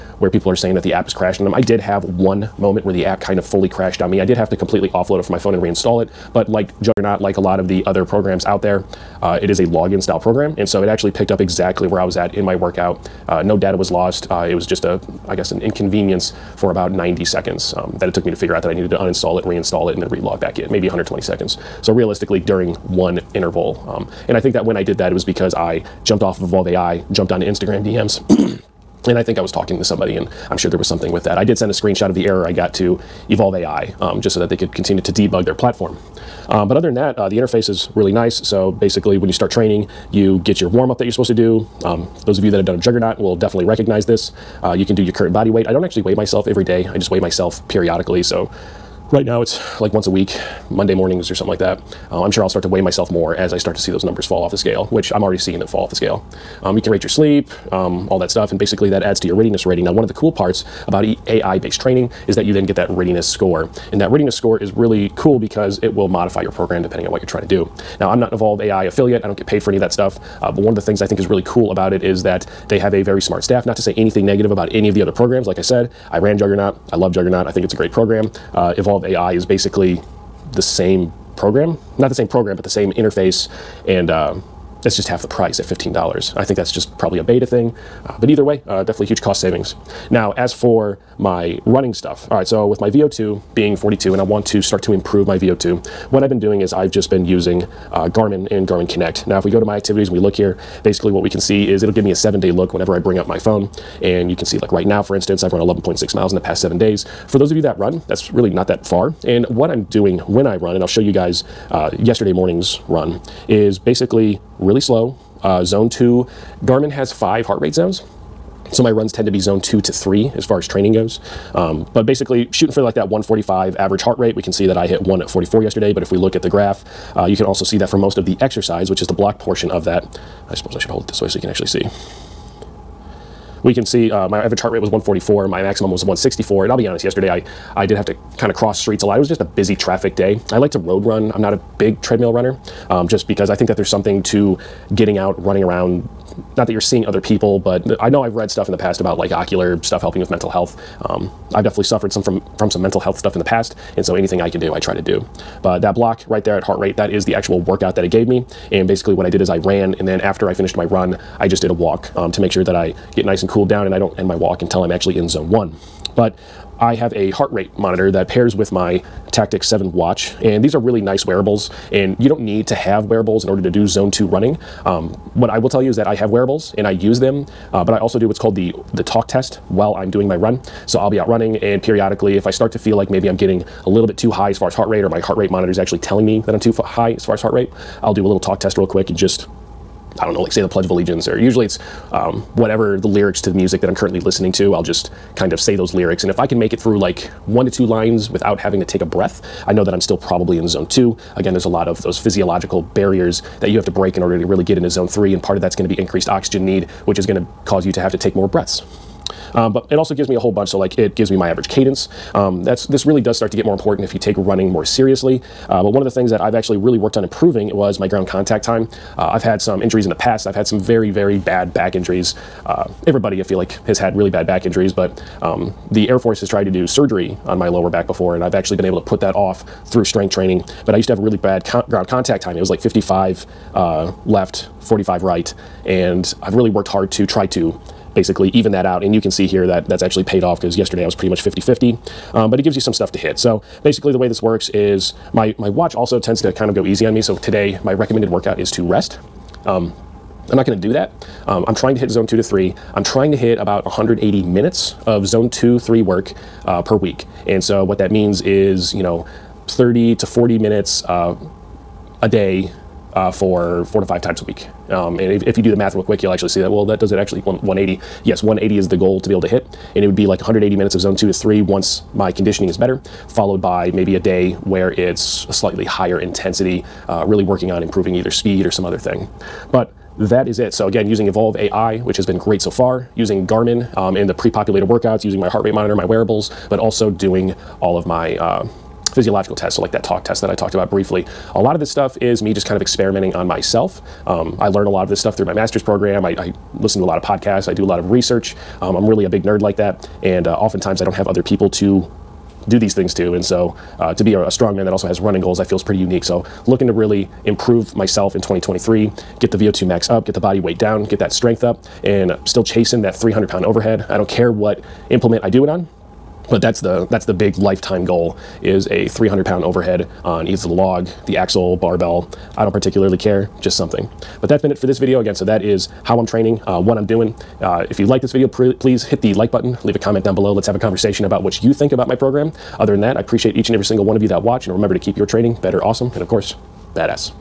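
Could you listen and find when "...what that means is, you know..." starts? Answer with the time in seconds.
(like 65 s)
257 s.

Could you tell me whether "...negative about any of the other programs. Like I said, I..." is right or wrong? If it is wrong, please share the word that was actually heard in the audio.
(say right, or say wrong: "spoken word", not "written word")
right.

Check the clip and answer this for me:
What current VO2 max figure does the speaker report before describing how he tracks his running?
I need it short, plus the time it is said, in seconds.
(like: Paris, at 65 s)
42, at 93 s.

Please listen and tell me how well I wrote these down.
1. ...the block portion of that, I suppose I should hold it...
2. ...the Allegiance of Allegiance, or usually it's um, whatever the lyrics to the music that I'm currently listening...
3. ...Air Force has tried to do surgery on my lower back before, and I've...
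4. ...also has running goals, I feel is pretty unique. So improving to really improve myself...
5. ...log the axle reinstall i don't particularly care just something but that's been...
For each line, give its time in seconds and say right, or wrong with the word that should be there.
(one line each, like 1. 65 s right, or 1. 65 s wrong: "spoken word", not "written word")
1. 129 s right
2. 190 s wrong: "Pledge", not "Allegiance"
3. 226 s right
4. 304 s wrong: "looking", not "improving"
5. 320 s wrong: "barbell", not "reinstall".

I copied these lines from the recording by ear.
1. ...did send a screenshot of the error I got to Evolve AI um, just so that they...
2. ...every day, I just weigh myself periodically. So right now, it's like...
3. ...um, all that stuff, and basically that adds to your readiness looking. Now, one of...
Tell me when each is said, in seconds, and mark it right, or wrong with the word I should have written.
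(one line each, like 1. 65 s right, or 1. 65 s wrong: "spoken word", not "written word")
1. 31 s right
2. 46 s right
3. 57 s wrong: "rating", not "looking".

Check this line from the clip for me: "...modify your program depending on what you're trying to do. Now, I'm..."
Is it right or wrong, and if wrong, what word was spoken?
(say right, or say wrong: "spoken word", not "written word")
right.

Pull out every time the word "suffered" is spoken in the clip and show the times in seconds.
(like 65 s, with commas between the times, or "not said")
151 s.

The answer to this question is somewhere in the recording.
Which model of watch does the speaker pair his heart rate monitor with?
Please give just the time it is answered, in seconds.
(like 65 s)
169 s.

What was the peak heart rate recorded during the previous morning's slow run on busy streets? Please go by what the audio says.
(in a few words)
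164.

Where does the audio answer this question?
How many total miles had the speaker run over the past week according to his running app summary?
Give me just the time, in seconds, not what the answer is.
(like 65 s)
105 s.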